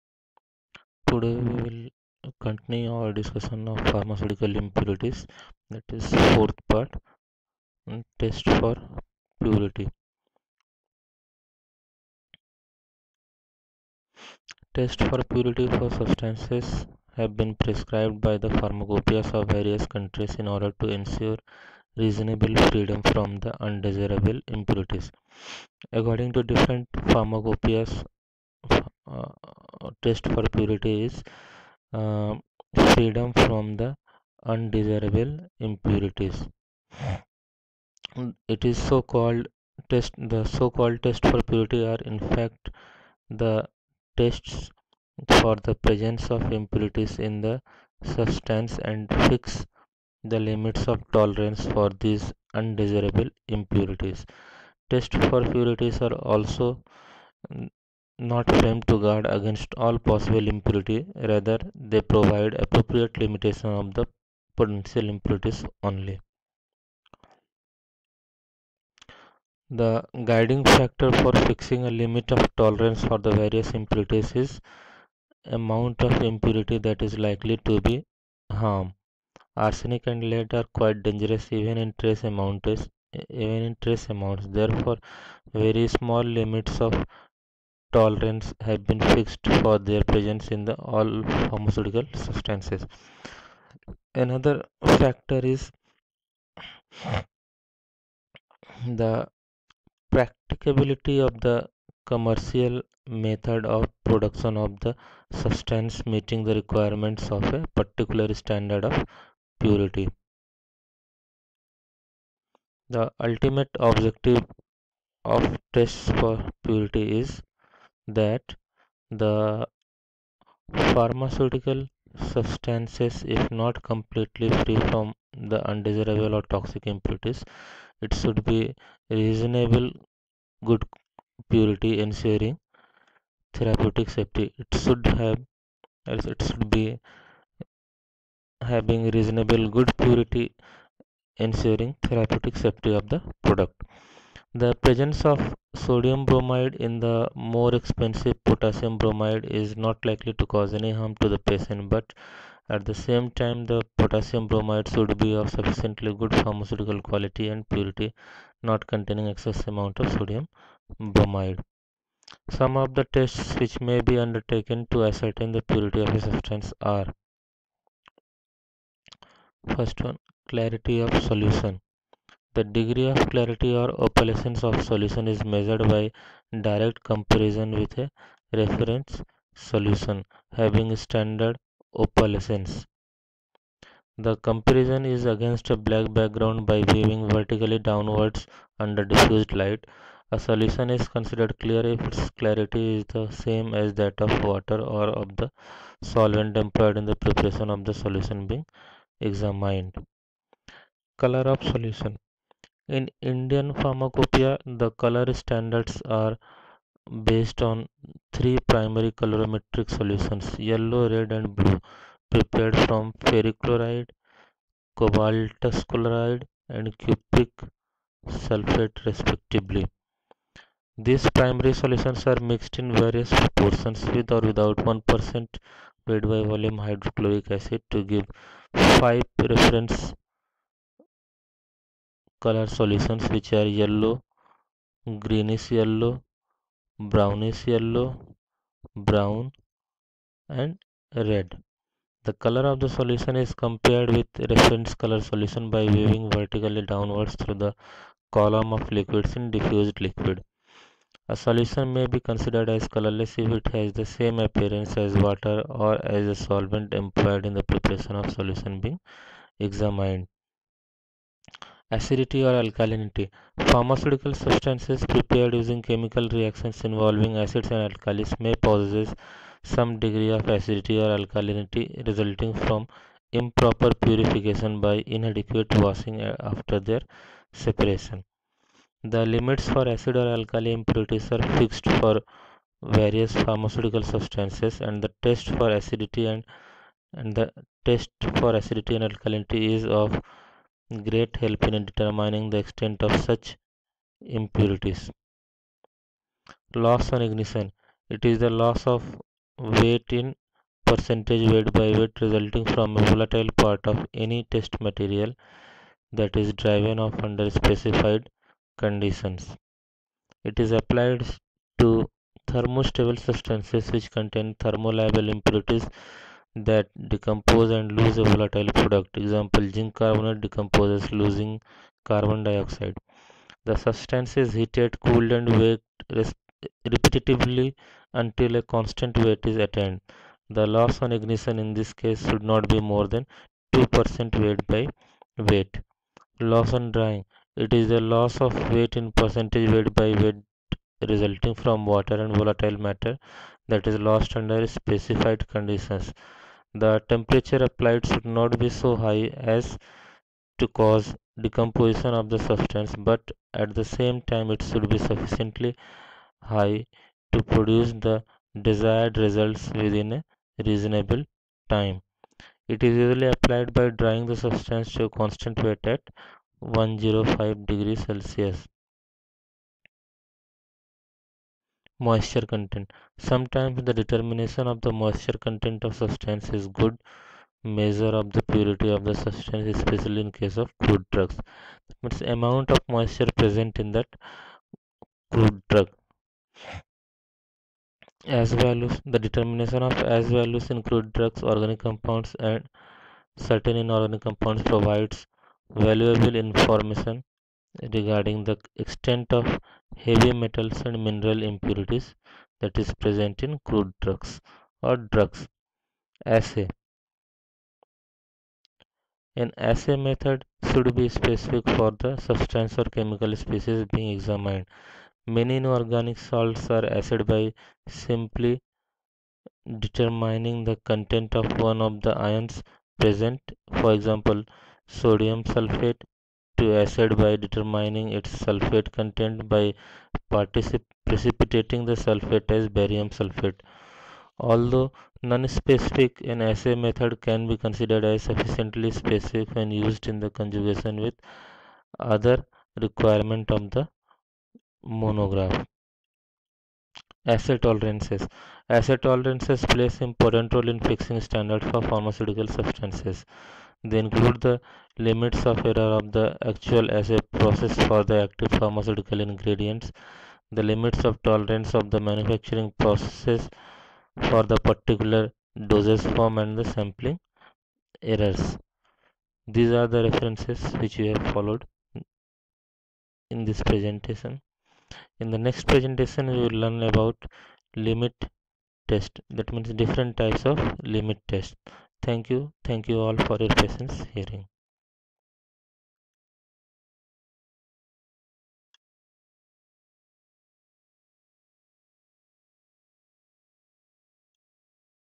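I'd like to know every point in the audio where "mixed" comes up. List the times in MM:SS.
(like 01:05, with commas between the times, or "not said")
03:42.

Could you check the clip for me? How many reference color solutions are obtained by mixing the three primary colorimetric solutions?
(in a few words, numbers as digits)
5.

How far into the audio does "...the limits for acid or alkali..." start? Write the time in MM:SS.
04:39.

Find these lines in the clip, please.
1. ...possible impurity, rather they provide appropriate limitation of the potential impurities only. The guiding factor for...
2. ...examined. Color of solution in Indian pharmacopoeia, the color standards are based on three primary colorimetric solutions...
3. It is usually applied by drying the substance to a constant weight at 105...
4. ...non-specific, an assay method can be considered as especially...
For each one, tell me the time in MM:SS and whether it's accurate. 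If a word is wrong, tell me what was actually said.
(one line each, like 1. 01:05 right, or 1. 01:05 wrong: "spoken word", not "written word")
1. 01:00 right
2. 03:19 right
3. 06:02 right
4. 07:15 wrong: "sufficiently", not "especially".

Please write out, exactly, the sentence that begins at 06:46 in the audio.
Assay An assay method should be specific for the substance or chemical species being examined.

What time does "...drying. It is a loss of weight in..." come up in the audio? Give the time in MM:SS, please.
05:36.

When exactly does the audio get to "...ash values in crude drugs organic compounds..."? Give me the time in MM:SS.
06:30.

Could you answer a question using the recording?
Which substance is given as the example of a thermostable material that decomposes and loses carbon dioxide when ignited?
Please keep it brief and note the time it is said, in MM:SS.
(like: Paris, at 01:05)
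Zinc carbonate, at 05:19.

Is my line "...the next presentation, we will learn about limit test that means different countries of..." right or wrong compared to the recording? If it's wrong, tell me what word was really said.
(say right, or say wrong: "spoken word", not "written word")
wrong: "types", not "countries".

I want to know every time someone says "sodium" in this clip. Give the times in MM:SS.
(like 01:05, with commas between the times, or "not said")
02:25, 02:40, 07:04.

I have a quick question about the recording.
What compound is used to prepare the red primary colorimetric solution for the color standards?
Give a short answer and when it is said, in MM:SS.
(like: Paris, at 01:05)
Cobaltous chloride, at 03:34.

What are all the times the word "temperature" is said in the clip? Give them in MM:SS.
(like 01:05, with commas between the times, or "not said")
05:47.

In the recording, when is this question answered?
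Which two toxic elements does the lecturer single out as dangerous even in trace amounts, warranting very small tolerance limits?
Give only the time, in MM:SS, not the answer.
01:19.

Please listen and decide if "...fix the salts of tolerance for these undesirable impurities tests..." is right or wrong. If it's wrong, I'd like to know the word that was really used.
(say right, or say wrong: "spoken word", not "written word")
wrong: "limits", not "salts".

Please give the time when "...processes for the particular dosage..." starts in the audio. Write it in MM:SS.
07:42.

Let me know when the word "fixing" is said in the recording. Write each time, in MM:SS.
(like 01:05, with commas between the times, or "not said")
01:11, 07:30.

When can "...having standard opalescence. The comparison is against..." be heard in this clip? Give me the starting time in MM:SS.
03:00.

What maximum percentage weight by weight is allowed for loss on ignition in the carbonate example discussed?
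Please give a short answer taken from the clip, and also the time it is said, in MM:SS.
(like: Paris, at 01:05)
2%, at 05:33.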